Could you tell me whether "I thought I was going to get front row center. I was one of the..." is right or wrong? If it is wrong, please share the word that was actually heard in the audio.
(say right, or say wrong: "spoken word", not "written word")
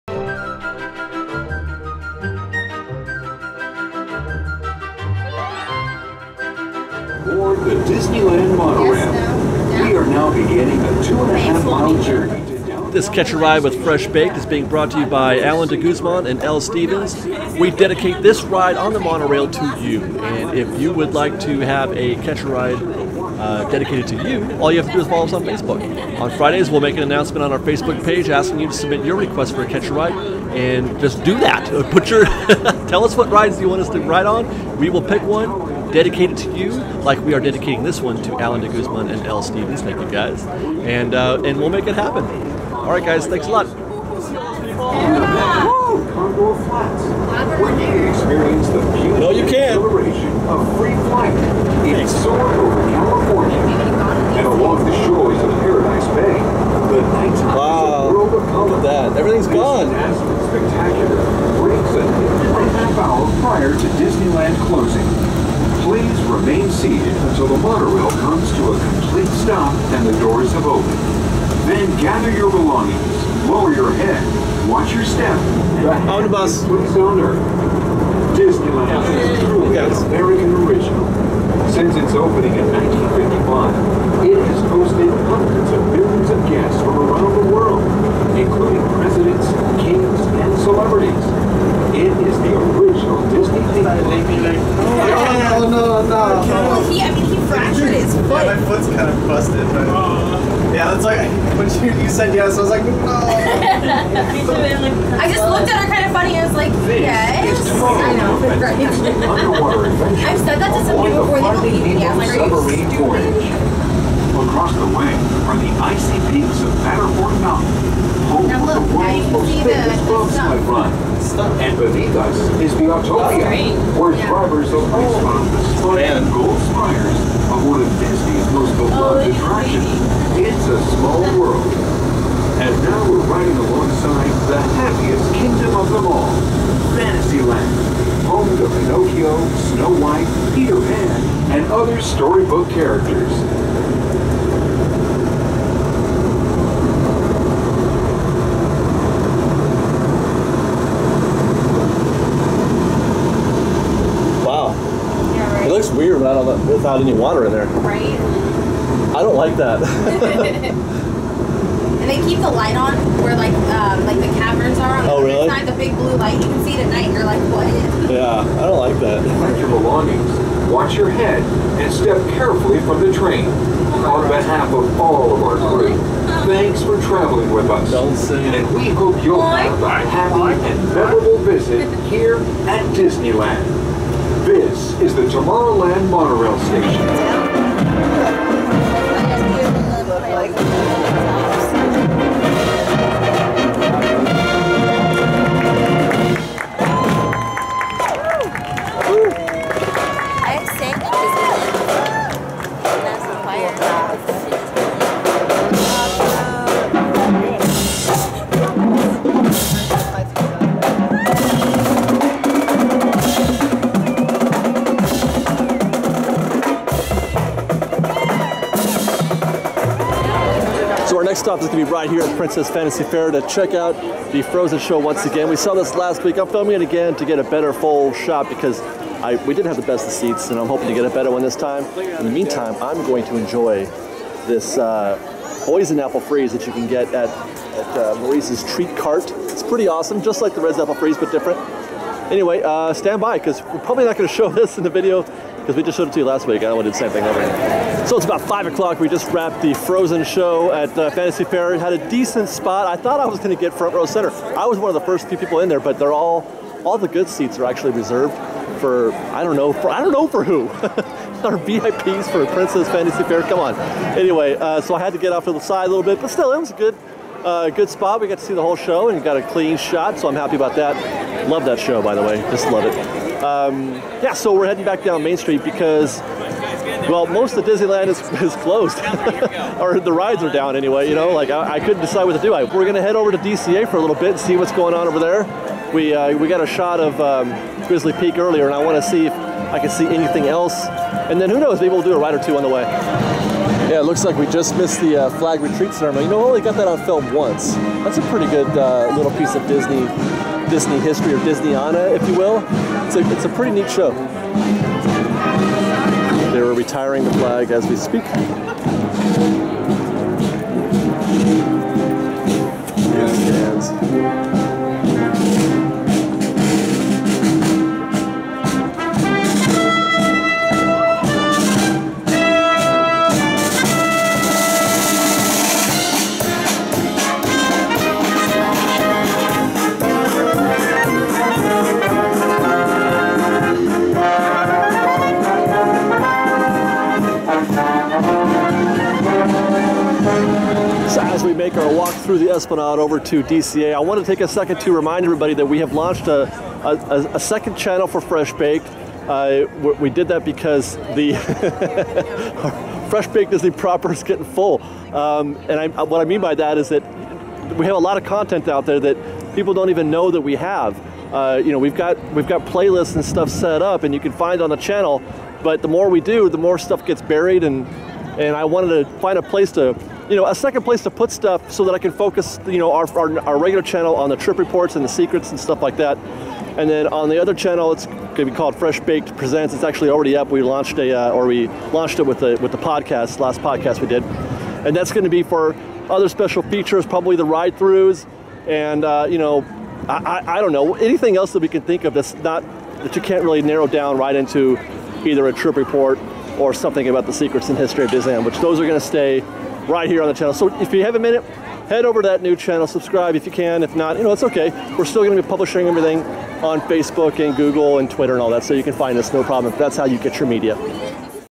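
right.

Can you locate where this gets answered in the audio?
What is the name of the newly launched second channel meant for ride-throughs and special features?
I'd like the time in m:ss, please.
6:18.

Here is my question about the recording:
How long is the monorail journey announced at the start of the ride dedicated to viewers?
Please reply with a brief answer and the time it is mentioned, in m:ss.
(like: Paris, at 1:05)
2.5 miles, at 0:11.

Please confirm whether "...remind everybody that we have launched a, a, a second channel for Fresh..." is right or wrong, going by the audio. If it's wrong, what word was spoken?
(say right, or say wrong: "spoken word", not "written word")
right.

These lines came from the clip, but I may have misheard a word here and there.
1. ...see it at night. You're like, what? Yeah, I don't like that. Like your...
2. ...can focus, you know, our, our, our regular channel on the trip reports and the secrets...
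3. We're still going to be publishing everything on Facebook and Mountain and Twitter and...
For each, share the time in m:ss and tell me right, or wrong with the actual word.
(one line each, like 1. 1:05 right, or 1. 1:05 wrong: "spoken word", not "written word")
1. 2:46 right
2. 6:11 right
3. 6:44 wrong: "Google", not "Mountain".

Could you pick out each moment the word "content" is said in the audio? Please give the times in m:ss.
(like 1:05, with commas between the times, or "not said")
5:58.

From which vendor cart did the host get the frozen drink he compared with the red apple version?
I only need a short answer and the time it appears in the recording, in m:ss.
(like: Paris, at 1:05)
Maurice's Treat Cart, at 3:58.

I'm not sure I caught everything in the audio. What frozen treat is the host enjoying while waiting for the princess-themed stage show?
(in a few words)
Poison apple freeze.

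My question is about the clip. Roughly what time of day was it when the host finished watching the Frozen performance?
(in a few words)
5 o'clock.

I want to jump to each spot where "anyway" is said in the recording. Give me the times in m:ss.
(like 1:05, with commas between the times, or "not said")
4:02, 4:24, 4:40.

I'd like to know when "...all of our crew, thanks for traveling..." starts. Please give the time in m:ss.
2:55.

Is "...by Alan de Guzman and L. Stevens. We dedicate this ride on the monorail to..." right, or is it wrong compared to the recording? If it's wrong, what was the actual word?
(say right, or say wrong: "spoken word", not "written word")
right.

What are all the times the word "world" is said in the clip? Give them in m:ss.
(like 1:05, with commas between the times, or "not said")
0:58, 1:27, 1:58.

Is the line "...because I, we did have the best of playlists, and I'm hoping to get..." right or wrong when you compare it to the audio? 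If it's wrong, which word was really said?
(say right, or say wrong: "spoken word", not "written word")
wrong: "seats", not "playlists".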